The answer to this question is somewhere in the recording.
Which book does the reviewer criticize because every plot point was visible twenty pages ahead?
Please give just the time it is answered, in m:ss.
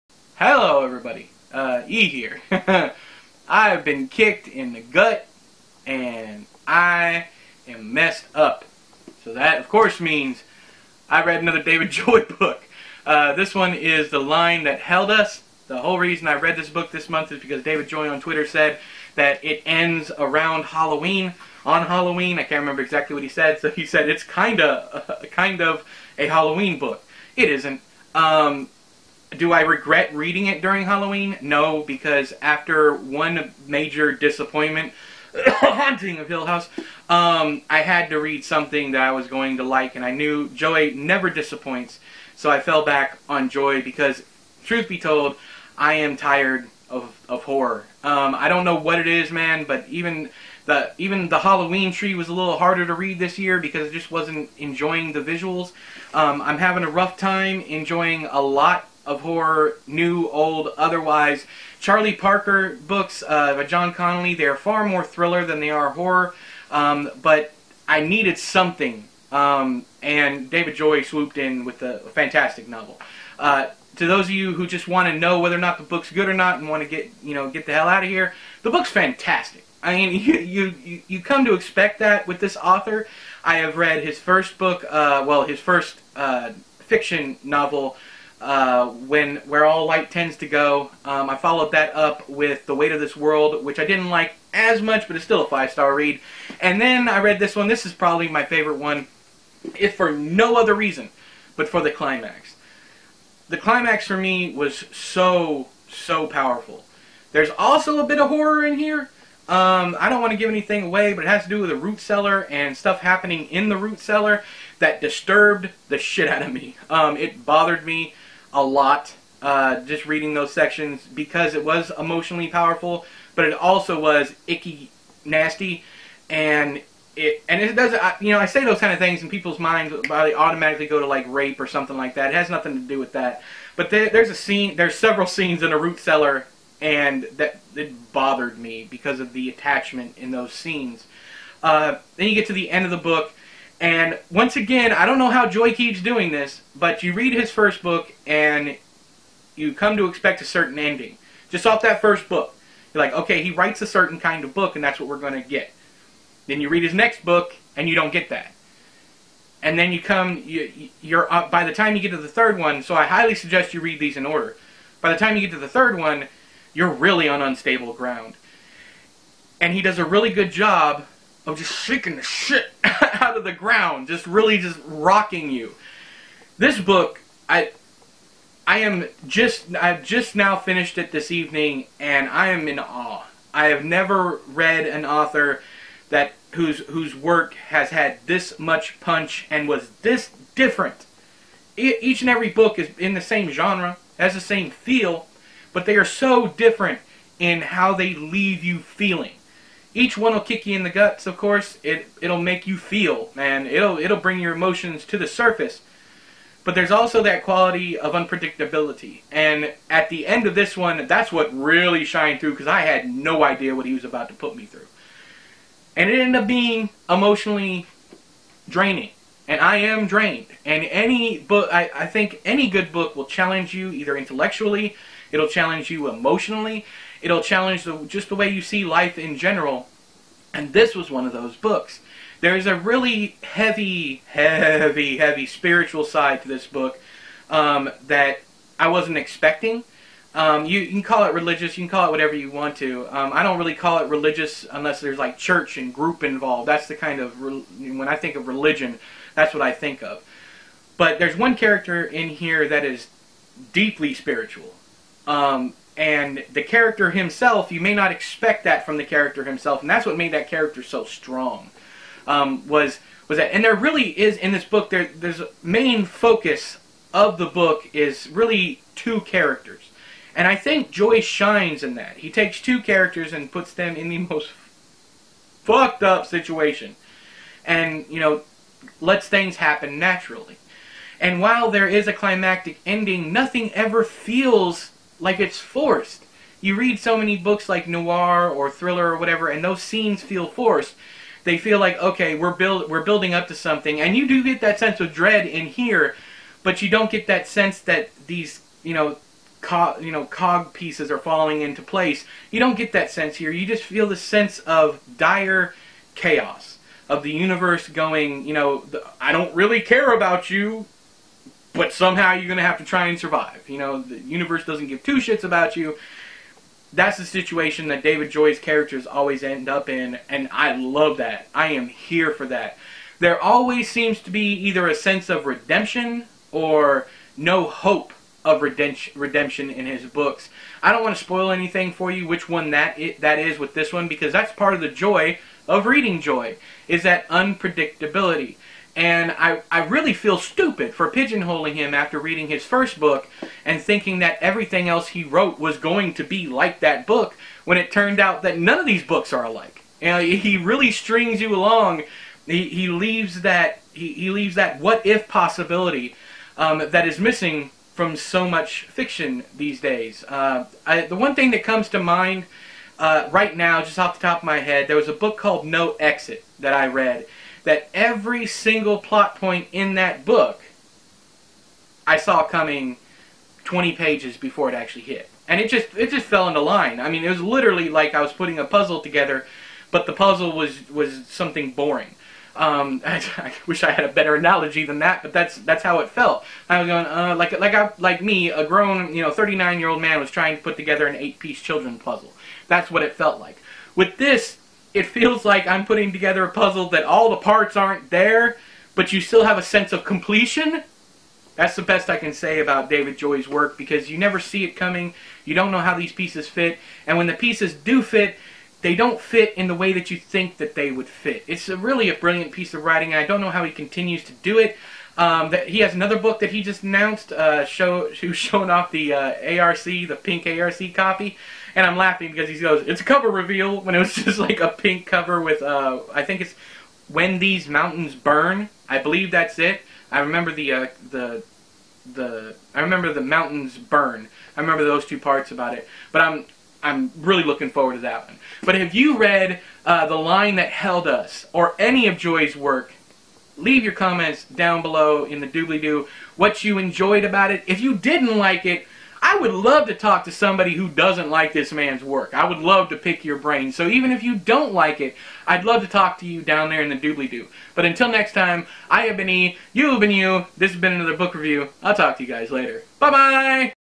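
6:05.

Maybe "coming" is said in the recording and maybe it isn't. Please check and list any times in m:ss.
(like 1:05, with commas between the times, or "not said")
6:12, 6:44.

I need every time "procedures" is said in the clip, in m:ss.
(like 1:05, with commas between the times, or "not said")
not said.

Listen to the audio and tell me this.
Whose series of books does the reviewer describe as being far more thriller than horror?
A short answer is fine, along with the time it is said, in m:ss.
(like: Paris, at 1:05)
John Connolly, at 1:03.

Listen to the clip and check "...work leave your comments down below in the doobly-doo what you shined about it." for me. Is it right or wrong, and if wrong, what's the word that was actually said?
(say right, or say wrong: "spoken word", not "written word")
wrong: "enjoyed", not "shined".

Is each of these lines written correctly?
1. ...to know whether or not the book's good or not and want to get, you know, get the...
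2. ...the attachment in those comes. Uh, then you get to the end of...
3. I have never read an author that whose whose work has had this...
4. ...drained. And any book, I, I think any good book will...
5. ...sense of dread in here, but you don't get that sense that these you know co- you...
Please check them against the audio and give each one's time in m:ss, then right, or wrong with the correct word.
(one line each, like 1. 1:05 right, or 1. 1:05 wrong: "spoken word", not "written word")
1. 1:15 right
2. 2:19 wrong: "scenes", not "comes"
3. 3:03 right
4. 3:40 right
5. 4:54 right.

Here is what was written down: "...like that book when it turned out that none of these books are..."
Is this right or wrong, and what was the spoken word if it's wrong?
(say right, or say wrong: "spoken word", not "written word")
right.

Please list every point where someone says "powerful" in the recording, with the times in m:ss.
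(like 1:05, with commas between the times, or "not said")
1:46, 2:02.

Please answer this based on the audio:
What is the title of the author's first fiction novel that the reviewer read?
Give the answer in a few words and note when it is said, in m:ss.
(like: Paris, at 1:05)
Where All Light Tends to Go, at 1:29.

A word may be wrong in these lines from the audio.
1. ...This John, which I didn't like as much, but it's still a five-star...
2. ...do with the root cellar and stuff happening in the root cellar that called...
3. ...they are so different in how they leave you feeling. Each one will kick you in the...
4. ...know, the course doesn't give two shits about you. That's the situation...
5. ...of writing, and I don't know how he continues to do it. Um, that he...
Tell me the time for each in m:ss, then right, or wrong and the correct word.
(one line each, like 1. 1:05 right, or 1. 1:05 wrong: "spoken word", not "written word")
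1. 1:32 wrong: "World", not "John"
2. 1:51 wrong: "disturbed", not "called"
3. 3:15 right
4. 5:13 wrong: "universe", not "course"
5. 6:52 right.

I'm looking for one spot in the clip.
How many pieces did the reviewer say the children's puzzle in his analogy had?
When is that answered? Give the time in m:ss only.
6:31.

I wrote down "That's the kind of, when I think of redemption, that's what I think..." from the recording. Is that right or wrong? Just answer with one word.
wrong.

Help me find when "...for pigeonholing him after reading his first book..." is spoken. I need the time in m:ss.
5:40.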